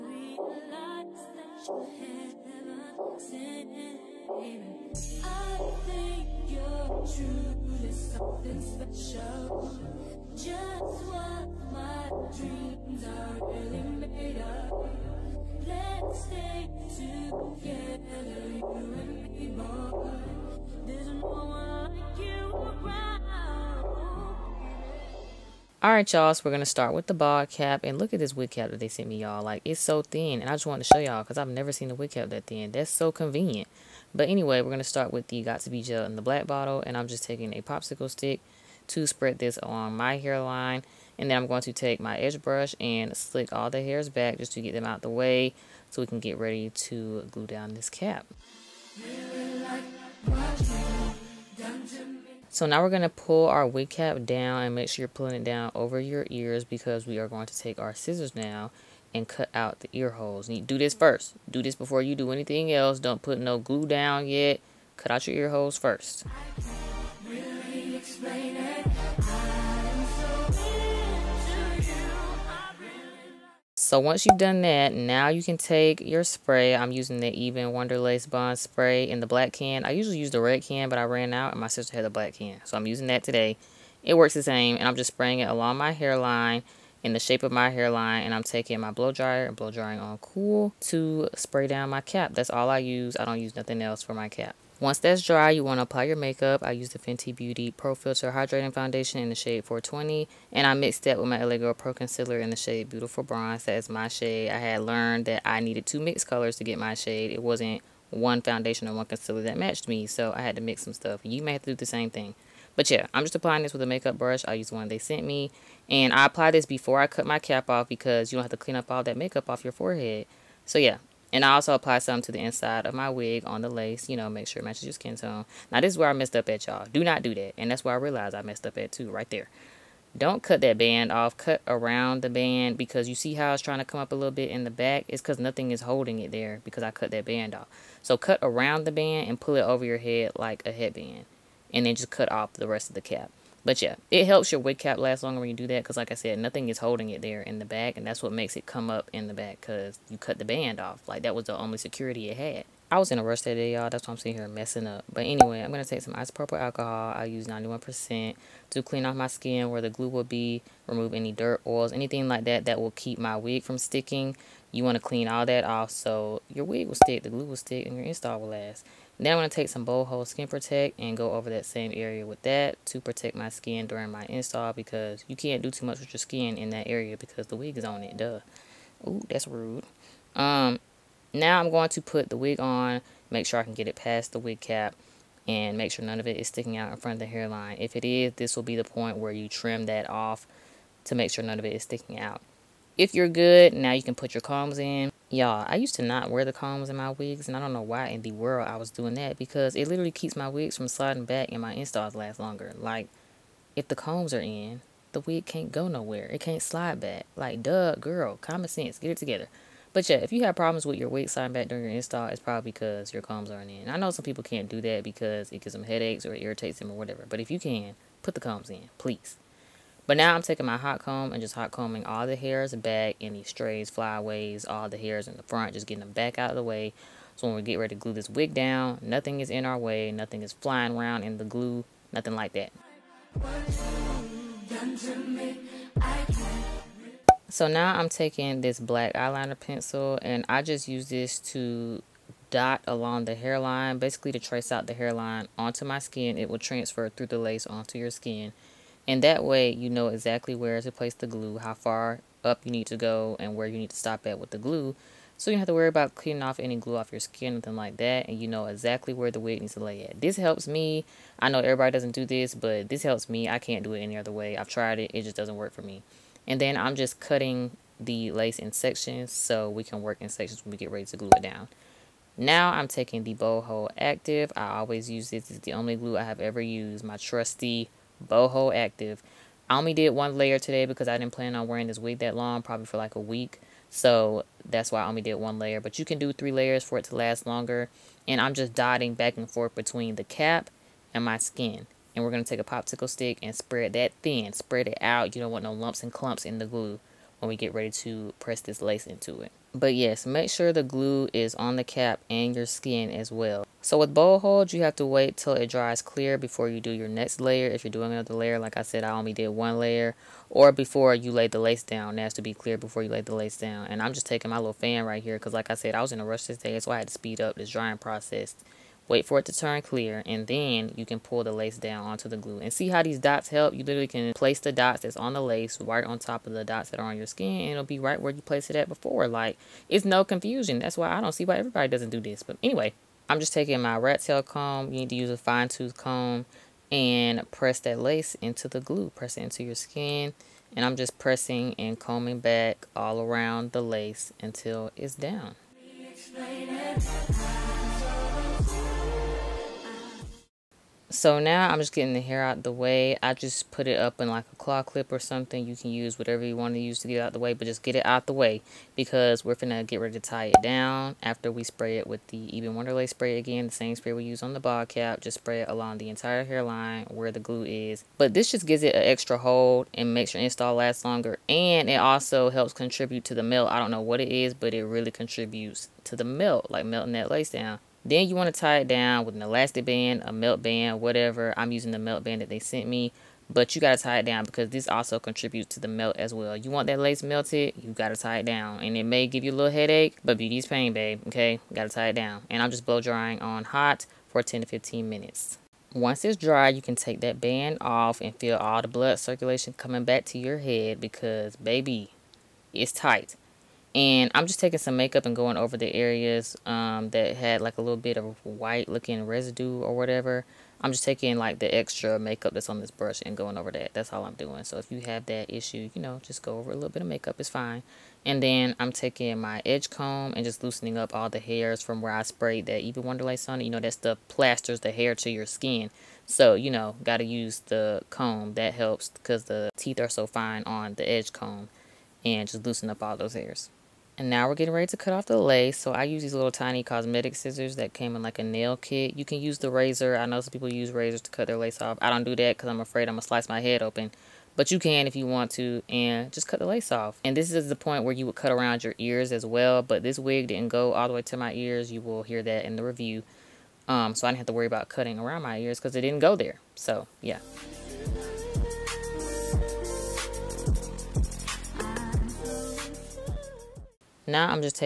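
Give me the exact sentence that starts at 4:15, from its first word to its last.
So you don't have to worry about cleaning off any glue off your skin, nothing like that.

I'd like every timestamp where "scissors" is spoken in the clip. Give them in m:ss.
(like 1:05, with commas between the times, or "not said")
0:57, 7:17.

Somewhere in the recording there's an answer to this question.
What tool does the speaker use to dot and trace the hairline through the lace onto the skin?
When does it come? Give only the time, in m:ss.
3:58.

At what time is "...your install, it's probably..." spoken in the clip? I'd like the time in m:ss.
3:31.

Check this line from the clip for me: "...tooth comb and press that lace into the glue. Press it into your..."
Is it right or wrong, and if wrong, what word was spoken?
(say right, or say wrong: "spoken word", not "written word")
right.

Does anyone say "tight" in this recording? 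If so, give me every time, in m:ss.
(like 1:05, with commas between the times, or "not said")
6:42.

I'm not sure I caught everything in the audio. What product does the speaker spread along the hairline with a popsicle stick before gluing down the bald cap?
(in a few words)
Got To Be Gel.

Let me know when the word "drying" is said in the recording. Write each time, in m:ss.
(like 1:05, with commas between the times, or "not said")
1:29, 5:17, 6:32.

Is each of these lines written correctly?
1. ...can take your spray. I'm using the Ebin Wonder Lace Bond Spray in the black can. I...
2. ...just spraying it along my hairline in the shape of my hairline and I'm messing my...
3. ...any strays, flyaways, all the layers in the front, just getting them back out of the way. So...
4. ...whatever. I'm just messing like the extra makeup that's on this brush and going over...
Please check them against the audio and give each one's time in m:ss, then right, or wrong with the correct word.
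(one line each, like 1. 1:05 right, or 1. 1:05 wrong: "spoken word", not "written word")
1. 1:15 right
2. 1:24 wrong: "taking", not "messing"
3. 3:43 wrong: "hairs", not "layers"
4. 6:49 wrong: "taking", not "messing".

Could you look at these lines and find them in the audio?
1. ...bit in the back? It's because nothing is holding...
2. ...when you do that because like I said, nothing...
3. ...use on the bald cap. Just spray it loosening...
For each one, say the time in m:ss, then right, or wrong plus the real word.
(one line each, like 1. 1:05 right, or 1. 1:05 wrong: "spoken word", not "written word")
1. 2:14 right
2. 2:25 right
3. 6:04 wrong: "along", not "loosening".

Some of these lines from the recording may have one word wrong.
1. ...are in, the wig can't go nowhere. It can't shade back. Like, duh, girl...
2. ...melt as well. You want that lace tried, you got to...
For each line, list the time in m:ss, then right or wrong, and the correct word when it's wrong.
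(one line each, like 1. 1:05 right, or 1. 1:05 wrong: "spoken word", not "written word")
1. 3:24 wrong: "slide", not "shade"
2. 6:25 wrong: "melted", not "tried".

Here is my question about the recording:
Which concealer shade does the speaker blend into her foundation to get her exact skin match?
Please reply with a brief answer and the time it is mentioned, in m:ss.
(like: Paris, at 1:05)
Beautiful Bronze, at 1:42.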